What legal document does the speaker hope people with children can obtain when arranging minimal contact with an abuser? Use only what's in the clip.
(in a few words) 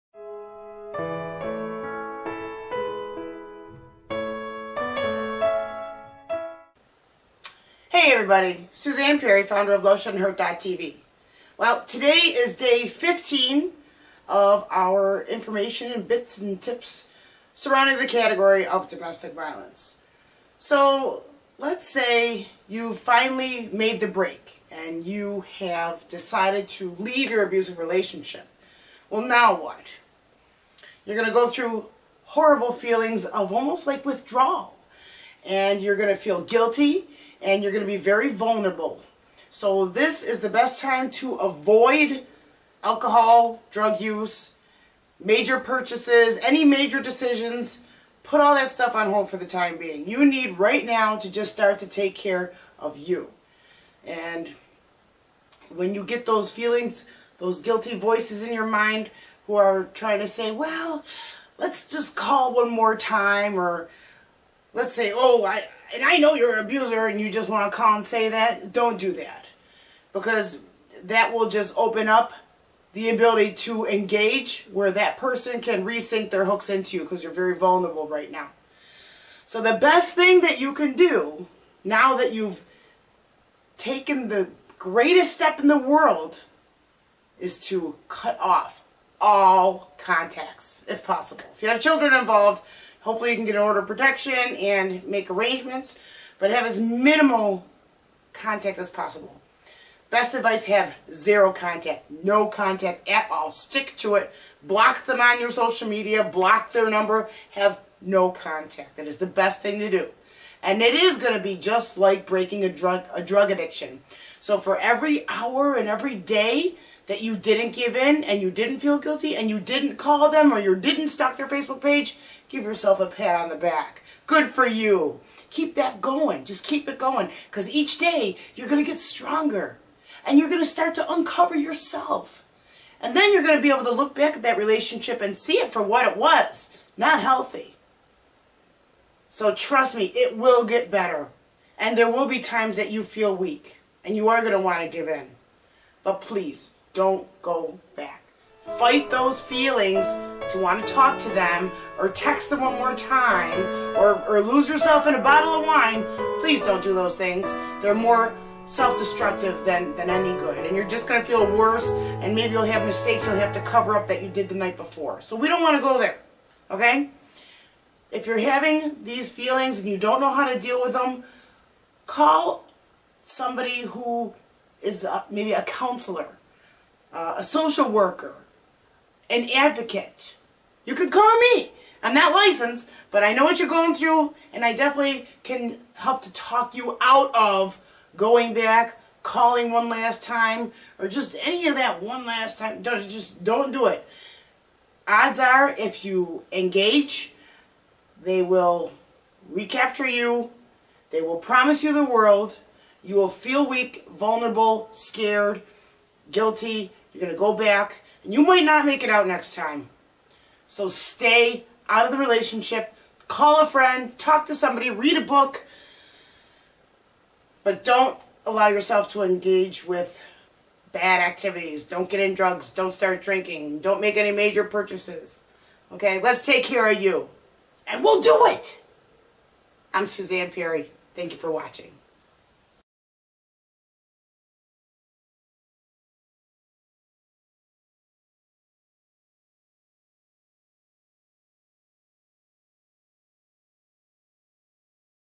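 order of protection.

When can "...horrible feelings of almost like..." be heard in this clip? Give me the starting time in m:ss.
0:32.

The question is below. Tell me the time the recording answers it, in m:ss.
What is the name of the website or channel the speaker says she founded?
0:09.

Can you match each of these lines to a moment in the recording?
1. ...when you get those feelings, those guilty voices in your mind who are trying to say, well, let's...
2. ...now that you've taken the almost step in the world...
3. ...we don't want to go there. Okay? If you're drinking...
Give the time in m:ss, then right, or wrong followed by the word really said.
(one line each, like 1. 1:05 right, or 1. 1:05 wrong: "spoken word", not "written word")
1. 0:55 right
2. 1:21 wrong: "greatest", not "almost"
3. 2:45 wrong: "having", not "drinking".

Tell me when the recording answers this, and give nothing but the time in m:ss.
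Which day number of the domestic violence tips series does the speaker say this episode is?
0:12.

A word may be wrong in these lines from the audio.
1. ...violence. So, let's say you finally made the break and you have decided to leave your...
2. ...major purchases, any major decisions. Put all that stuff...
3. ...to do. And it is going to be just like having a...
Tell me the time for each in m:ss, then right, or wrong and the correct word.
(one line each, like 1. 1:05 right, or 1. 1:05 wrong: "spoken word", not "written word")
1. 0:19 right
2. 0:45 right
3. 1:49 wrong: "breaking", not "having".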